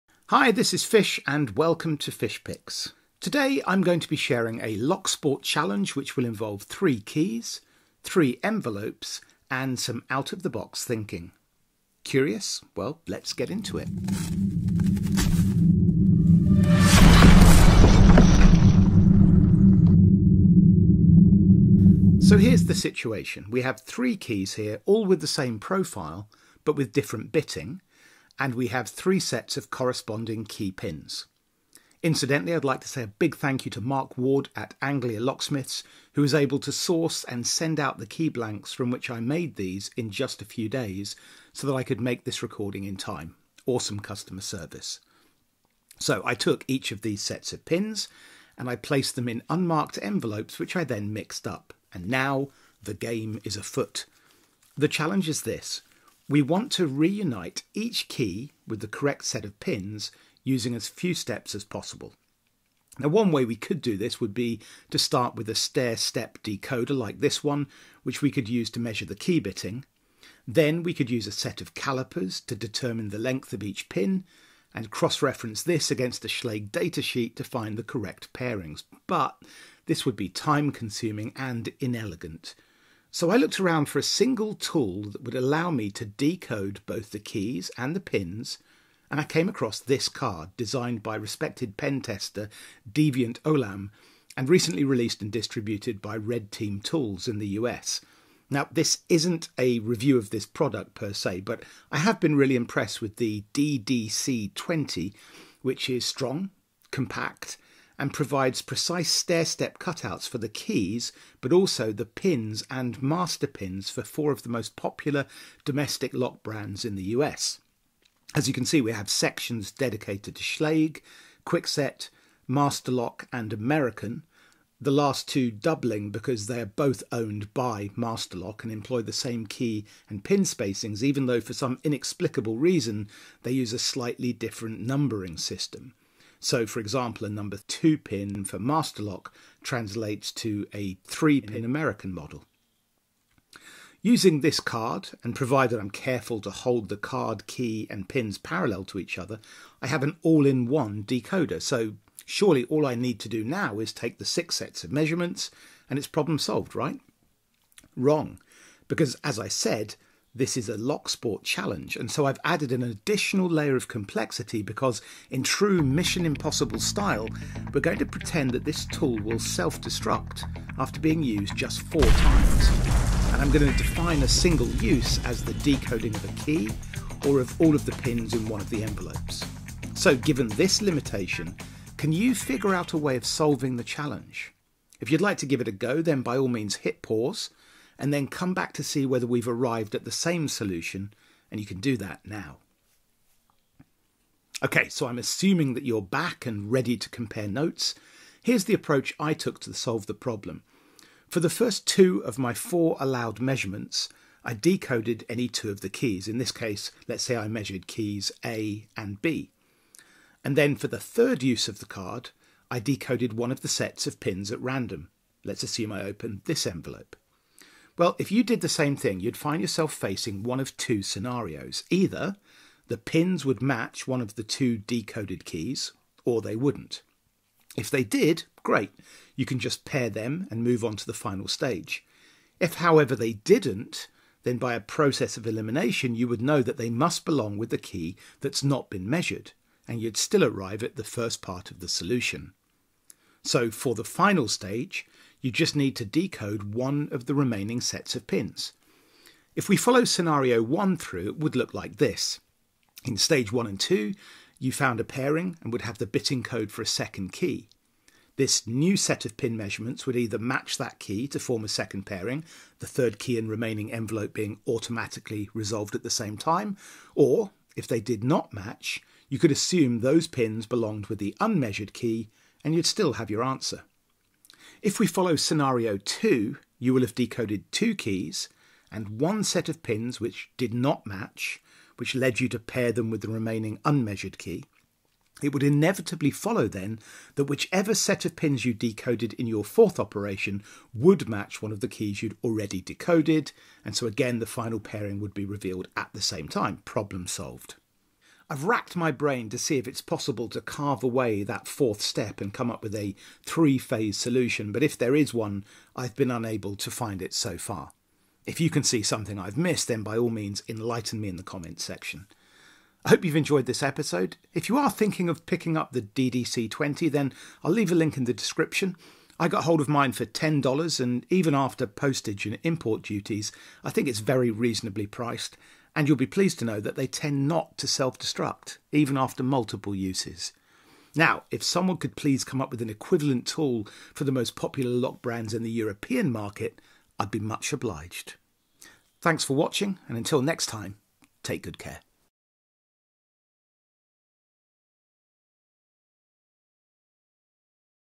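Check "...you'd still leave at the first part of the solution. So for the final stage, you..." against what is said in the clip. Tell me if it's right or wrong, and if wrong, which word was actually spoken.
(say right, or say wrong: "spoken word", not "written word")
wrong: "arrive", not "leave".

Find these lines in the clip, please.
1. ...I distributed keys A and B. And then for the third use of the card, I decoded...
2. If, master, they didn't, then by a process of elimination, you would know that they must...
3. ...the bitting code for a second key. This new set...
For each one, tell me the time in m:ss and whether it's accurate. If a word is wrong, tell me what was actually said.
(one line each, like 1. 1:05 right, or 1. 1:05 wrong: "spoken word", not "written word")
1. 3:27 wrong: "measured", not "distributed"
2. 3:52 wrong: "however", not "master"
3. 4:15 right.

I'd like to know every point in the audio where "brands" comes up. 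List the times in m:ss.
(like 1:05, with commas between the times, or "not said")
1:56, 5:35.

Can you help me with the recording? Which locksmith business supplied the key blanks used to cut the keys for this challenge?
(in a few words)
Anglia Locksmiths.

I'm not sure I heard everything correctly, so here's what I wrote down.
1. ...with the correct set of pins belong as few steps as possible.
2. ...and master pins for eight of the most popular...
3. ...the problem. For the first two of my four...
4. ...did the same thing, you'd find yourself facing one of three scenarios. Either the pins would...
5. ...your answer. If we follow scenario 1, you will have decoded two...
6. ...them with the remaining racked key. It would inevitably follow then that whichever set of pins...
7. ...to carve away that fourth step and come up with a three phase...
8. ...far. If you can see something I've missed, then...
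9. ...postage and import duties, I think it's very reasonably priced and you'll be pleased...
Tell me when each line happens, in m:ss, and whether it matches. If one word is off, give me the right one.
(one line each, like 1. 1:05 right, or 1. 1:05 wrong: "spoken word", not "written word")
1. 0:58 wrong: "using", not "belong"
2. 1:52 wrong: "four", not "eight"
3. 3:20 right
4. 3:38 wrong: "two", not "three"
5. 4:33 wrong: "2", not "1"
6. 4:42 wrong: "unmeasured", not "racked"
7. 5:00 right
8. 5:07 right
9. 5:21 right.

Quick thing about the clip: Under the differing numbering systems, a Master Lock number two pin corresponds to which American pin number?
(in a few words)
3.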